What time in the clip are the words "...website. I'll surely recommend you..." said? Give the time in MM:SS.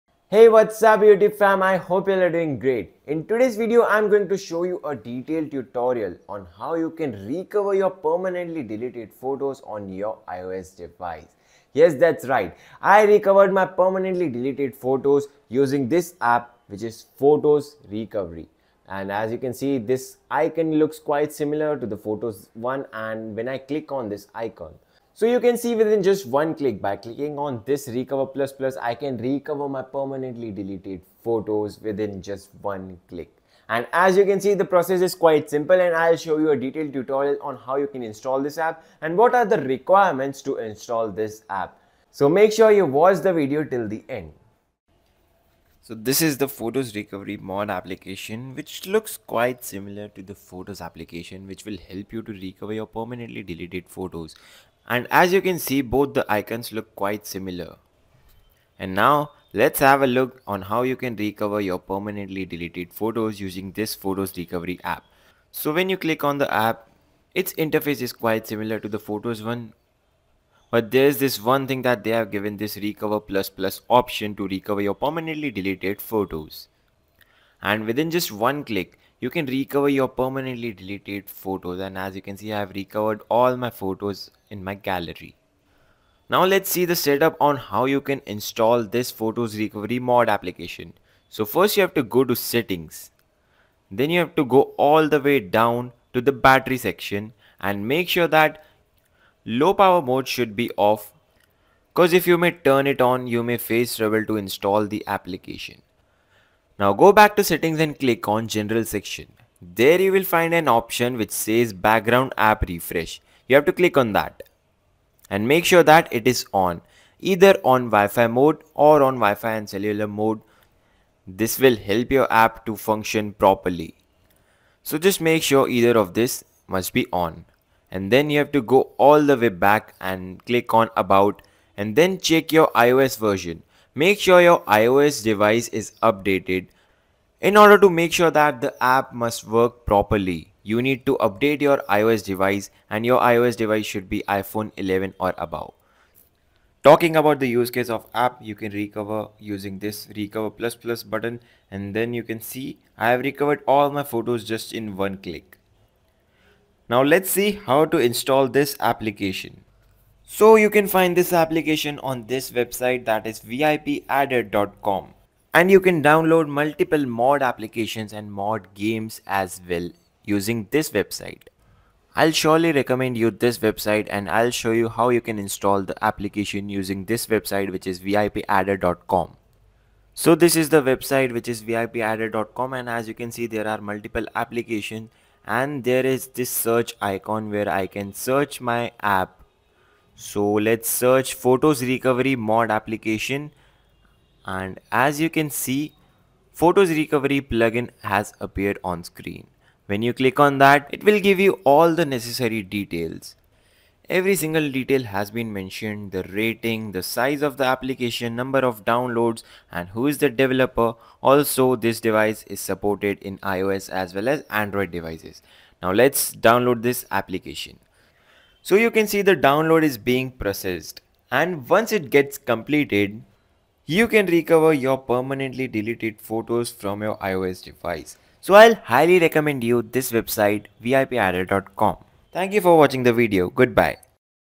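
02:50.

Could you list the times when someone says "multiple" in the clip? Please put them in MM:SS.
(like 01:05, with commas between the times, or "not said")
02:46, 03:03.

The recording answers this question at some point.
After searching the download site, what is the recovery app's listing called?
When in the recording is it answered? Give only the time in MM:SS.
03:16.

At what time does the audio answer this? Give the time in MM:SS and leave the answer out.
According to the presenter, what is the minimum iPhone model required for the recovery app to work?
02:24.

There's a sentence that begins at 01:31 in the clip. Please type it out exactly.
So first you have to go to settings.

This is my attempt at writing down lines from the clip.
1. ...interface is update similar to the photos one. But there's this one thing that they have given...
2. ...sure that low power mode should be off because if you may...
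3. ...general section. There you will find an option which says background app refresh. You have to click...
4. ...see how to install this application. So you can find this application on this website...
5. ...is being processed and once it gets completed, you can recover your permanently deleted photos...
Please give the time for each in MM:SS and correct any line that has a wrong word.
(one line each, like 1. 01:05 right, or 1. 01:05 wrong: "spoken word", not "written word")
1. 01:07 wrong: "quite", not "update"
2. 01:38 right
3. 01:48 right
4. 02:37 right
5. 03:39 right.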